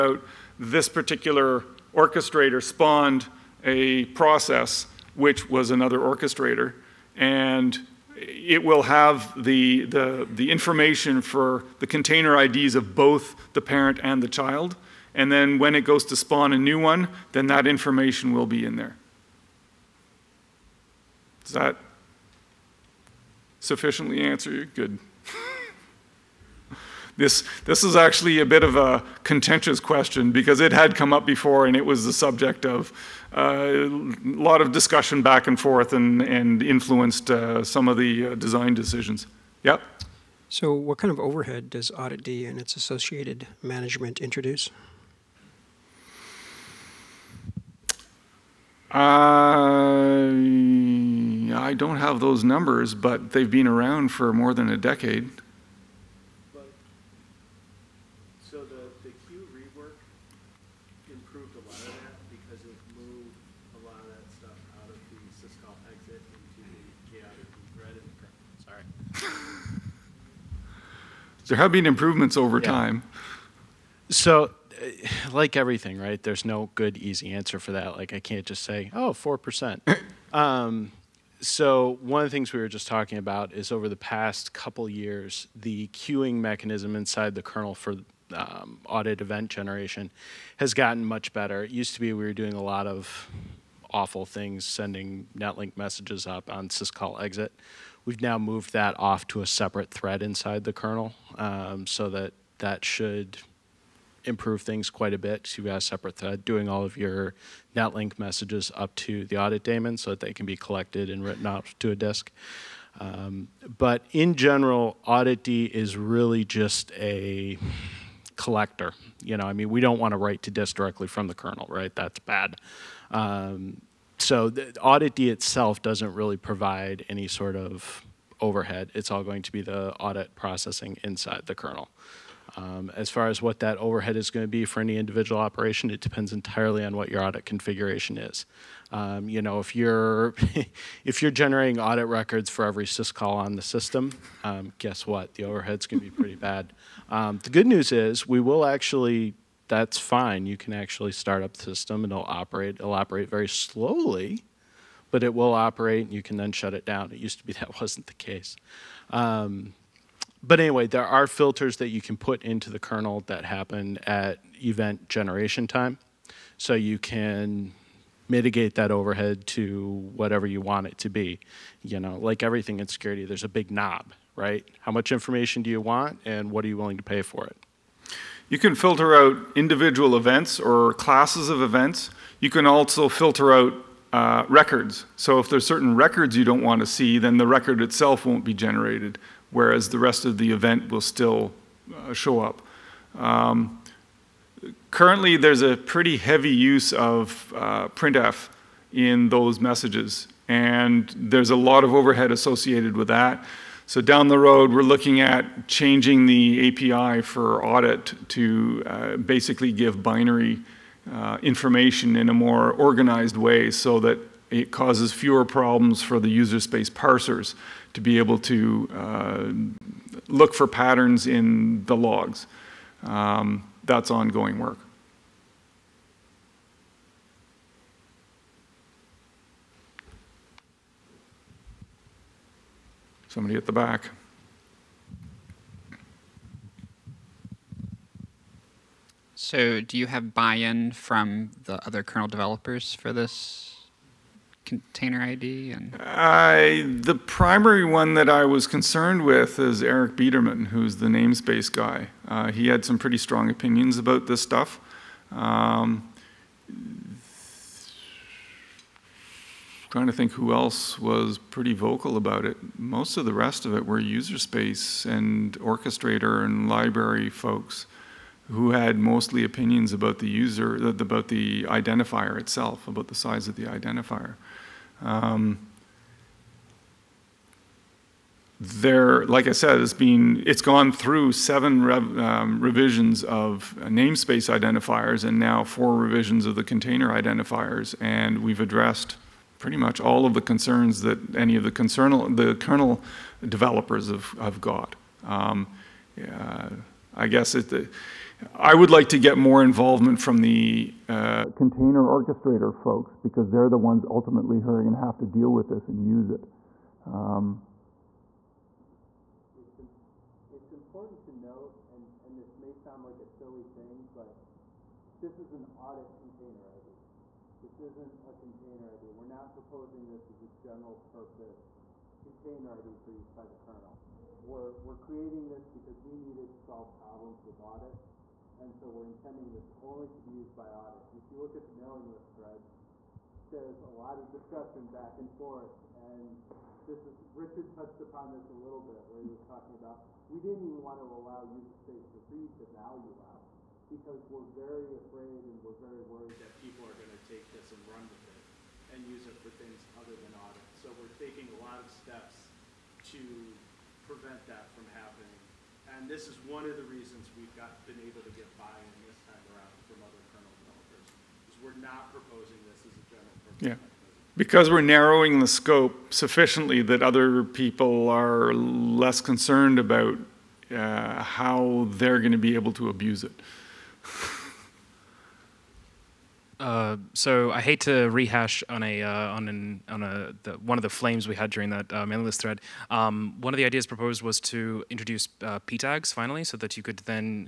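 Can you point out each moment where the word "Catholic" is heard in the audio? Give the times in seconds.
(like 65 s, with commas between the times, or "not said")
not said.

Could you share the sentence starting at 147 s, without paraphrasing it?
Um, the good news is we will actually that's fine.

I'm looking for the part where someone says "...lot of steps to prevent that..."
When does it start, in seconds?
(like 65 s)
351 s.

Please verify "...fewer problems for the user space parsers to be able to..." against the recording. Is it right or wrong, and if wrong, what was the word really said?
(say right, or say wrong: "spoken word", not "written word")
right.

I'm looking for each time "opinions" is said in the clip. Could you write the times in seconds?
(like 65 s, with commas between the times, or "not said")
253 s, 269 s.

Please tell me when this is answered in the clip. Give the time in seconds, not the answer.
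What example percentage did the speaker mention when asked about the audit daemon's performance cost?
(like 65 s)
79 s.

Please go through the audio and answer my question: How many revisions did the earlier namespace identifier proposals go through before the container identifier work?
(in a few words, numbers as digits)
7.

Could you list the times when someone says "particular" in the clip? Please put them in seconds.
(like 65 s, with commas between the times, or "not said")
0 s.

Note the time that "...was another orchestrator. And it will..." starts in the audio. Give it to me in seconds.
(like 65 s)
5 s.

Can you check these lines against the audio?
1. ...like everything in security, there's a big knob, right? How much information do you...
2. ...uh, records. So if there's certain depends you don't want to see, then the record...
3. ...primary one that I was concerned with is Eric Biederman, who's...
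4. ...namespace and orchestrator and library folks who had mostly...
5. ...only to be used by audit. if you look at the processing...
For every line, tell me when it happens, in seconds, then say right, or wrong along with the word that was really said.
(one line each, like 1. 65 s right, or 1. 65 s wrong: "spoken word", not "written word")
1. 172 s right
2. 184 s wrong: "records", not "depends"
3. 247 s right
4. 264 s wrong: "space", not "namespace"
5. 329 s wrong: "mailing", not "processing".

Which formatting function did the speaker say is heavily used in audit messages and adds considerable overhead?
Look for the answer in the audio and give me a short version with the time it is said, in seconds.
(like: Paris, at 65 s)
printf, at 197 s.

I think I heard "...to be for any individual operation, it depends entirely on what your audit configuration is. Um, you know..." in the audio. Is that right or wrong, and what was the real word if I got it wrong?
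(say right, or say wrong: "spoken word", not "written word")
right.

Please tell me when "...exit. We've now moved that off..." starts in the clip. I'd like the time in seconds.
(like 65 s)
97 s.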